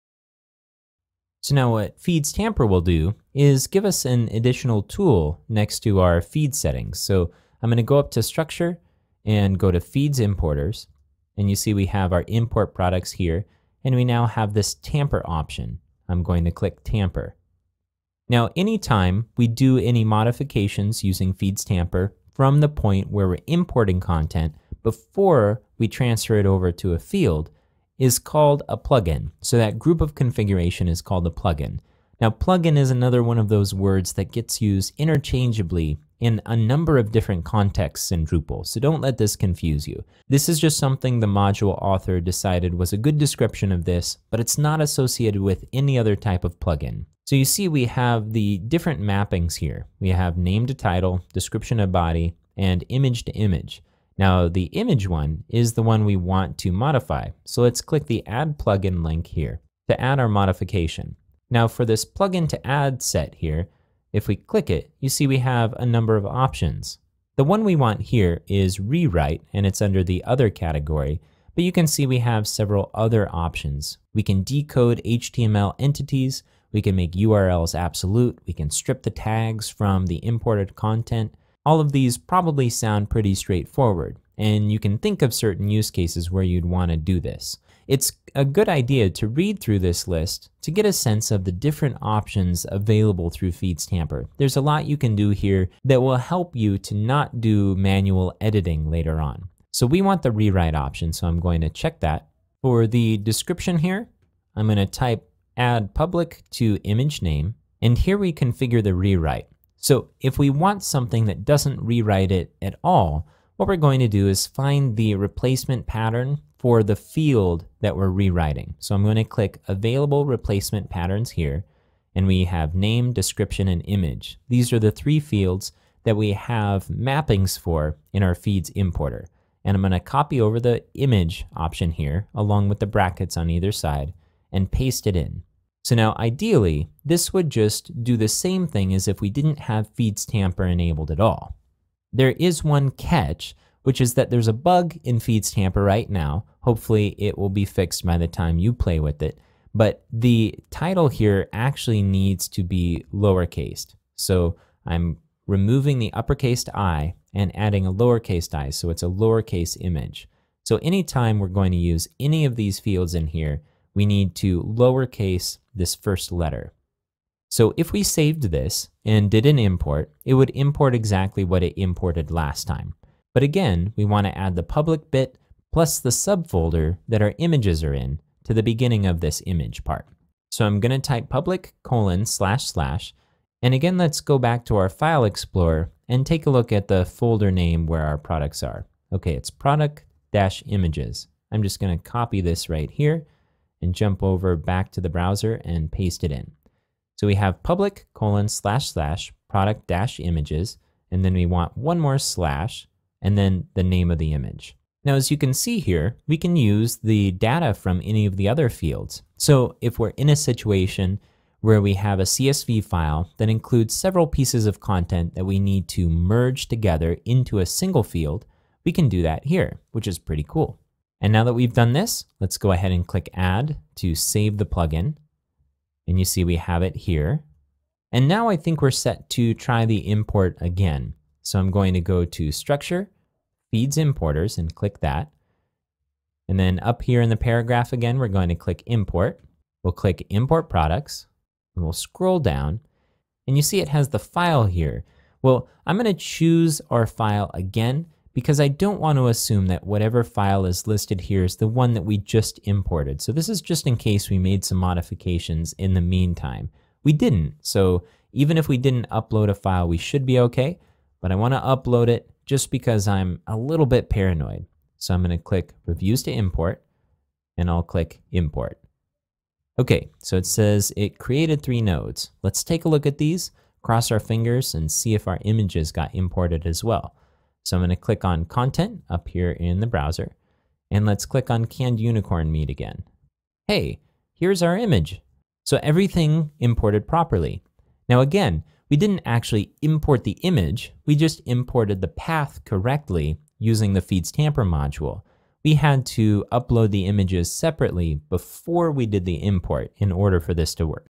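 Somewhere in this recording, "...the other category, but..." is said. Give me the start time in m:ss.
1:10.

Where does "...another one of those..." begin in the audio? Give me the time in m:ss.
0:32.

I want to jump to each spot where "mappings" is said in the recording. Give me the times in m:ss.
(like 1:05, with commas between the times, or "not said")
0:48, 2:06.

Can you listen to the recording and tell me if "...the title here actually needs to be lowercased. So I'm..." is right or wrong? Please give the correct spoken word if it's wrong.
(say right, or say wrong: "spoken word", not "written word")
right.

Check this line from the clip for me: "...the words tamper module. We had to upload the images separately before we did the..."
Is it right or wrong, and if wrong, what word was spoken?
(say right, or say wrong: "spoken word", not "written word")
wrong: "feeds", not "words".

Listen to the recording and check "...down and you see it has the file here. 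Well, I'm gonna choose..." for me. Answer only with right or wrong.
right.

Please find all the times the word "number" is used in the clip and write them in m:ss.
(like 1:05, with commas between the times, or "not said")
0:36, 1:05.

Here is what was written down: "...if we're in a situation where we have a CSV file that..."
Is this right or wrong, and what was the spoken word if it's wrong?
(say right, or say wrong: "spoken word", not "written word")
right.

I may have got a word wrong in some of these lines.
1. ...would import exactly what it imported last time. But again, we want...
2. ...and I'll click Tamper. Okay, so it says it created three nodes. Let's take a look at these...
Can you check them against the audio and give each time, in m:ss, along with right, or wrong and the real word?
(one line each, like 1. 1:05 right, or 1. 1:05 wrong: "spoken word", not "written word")
1. 2:50 right
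2. 4:27 wrong: "Import", not "Tamper".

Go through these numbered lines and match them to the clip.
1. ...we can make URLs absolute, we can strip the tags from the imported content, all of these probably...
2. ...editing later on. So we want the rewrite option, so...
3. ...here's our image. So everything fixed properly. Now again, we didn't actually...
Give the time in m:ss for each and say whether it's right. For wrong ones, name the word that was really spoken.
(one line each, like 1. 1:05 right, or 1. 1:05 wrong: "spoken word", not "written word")
1. 1:16 right
2. 1:38 right
3. 4:44 wrong: "imported", not "fixed".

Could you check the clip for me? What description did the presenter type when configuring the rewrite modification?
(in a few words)
add public to image name.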